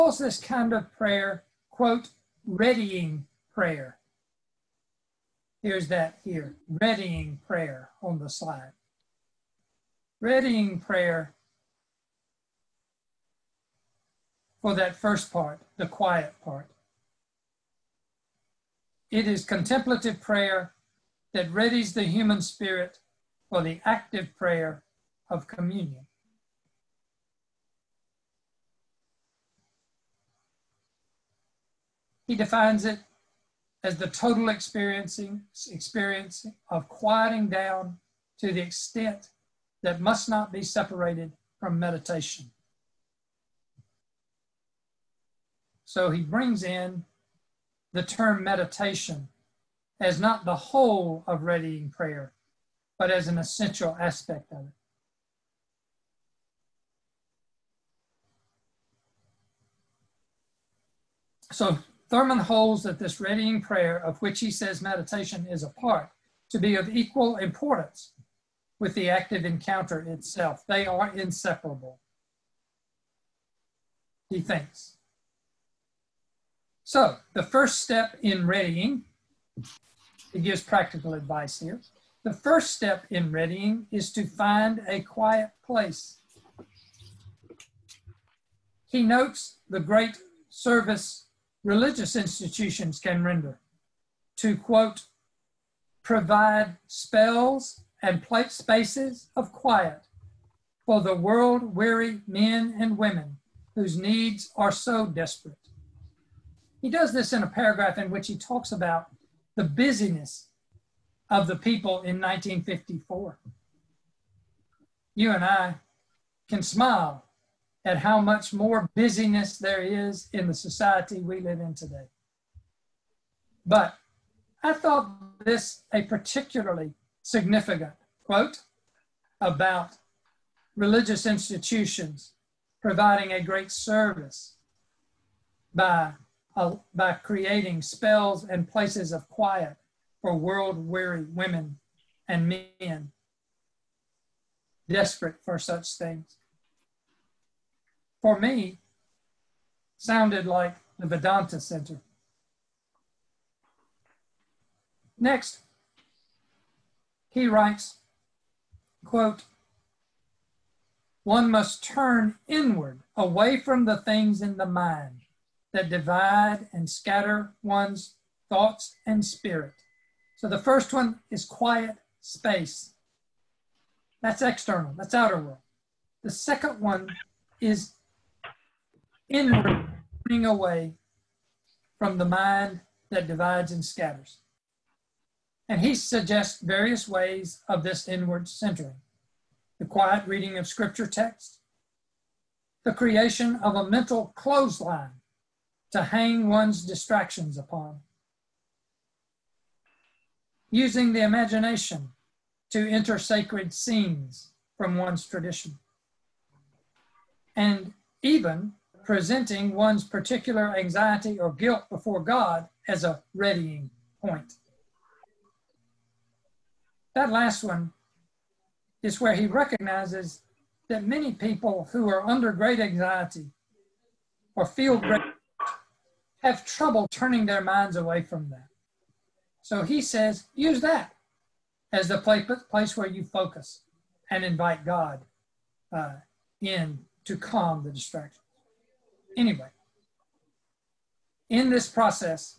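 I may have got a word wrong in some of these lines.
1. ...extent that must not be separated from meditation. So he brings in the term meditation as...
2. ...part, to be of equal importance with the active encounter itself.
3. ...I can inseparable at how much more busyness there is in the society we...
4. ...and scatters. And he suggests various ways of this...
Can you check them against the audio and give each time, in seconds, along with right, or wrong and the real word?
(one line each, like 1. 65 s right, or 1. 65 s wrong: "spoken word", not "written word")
1. 38 s right
2. 65 s right
3. 115 s wrong: "smile", not "inseparable"
4. 183 s right.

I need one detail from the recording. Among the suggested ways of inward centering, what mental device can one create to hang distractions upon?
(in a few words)
A mental clothesline.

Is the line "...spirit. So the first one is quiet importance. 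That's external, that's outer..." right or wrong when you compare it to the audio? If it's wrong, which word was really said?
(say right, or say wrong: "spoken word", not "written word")
wrong: "space", not "importance".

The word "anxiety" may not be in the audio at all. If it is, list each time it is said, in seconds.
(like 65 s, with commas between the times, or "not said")
210 s, 222 s.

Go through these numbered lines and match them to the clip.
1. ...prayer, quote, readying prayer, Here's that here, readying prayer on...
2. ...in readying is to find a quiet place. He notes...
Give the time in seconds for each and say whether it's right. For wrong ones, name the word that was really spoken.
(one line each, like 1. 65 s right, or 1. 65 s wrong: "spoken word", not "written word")
1. 0 s right
2. 83 s right.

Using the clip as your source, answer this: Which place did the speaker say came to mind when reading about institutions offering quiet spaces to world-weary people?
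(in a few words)
The Vedanta Center.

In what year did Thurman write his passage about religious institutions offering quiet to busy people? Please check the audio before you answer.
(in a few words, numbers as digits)
1954.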